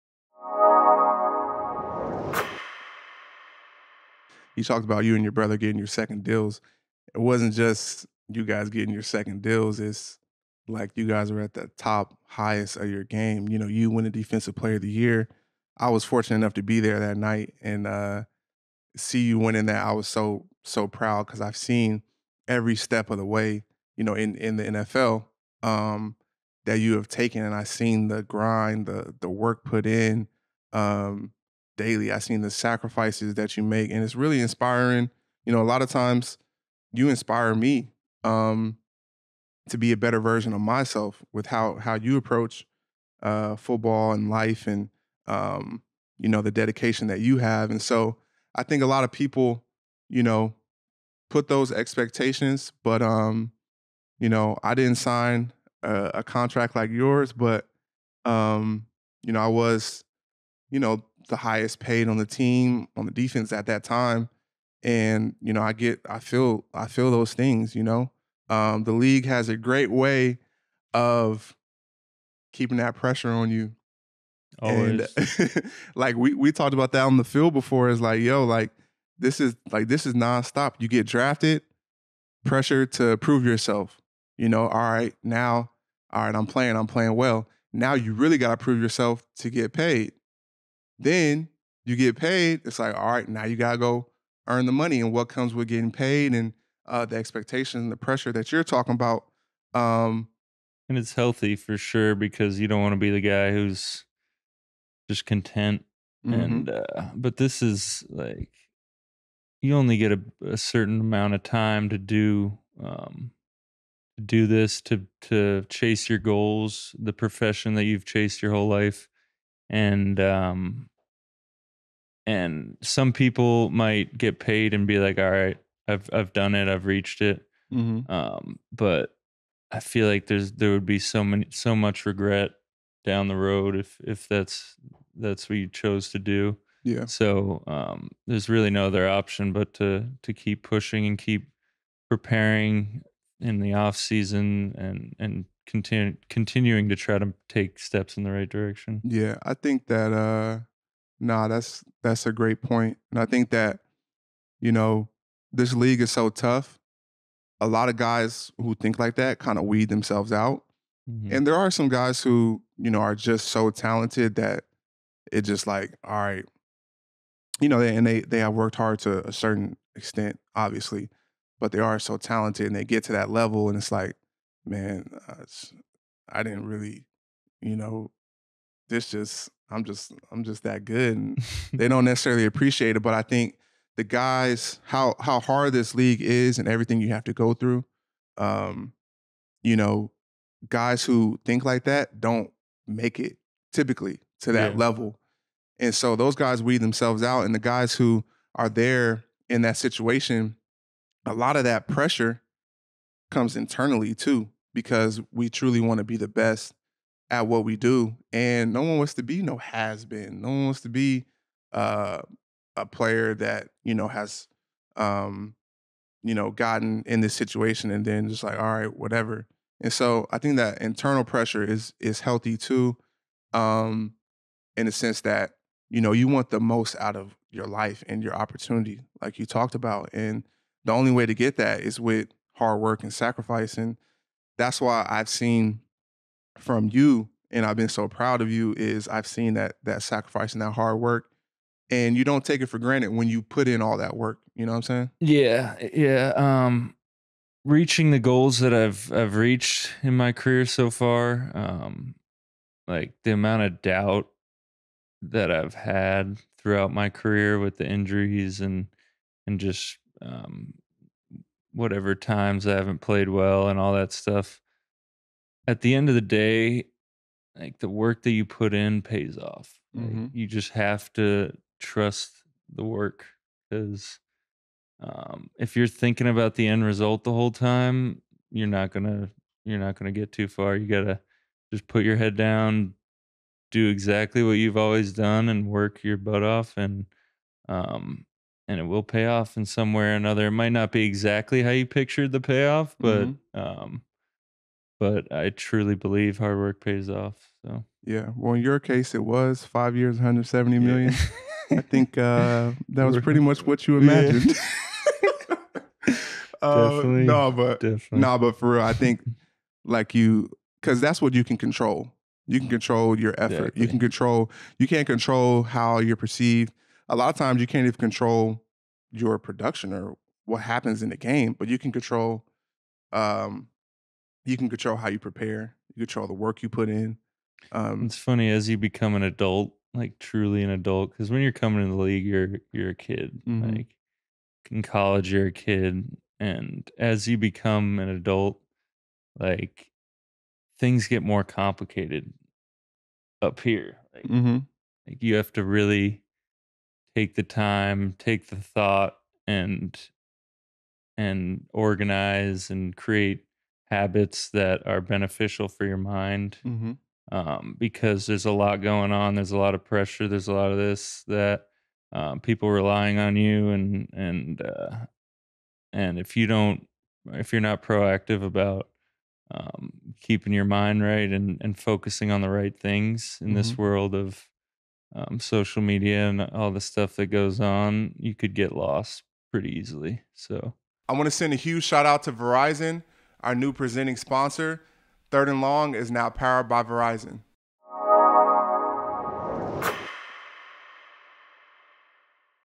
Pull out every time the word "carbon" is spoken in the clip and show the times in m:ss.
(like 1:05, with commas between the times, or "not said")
not said.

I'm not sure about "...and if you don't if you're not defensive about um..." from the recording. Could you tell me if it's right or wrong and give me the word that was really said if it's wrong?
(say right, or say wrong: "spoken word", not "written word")
wrong: "proactive", not "defensive".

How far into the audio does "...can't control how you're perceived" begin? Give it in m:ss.
5:14.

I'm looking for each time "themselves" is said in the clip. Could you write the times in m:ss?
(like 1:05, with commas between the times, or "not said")
2:39, 3:16.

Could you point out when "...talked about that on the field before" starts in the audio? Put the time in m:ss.
1:16.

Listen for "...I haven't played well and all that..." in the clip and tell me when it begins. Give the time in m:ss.
4:22.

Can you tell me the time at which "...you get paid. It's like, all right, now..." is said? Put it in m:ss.
1:31.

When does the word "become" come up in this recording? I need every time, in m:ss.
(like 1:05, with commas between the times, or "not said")
5:28, 5:37.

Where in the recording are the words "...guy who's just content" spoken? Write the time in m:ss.
1:43.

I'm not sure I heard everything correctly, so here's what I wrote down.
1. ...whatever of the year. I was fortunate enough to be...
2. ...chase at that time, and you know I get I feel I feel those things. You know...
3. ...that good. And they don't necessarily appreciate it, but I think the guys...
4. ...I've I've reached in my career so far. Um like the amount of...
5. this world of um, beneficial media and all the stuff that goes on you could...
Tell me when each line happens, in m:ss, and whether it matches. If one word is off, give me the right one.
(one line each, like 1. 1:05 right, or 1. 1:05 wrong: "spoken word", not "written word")
1. 0:14 wrong: "player", not "whatever"
2. 1:03 wrong: "defense", not "chase"
3. 3:00 right
4. 4:08 right
5. 6:13 wrong: "social", not "beneficial".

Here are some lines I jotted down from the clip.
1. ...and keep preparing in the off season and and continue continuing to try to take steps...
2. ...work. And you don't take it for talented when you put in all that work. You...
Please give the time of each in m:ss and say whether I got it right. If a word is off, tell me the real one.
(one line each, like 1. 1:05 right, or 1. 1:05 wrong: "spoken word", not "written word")
1. 2:21 right
2. 4:00 wrong: "granted", not "talented".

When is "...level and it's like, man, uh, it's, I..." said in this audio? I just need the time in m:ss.
2:53.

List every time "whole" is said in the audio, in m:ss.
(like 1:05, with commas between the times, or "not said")
1:58, 4:37.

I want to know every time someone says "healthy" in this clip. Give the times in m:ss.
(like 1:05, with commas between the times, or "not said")
1:41, 3:42.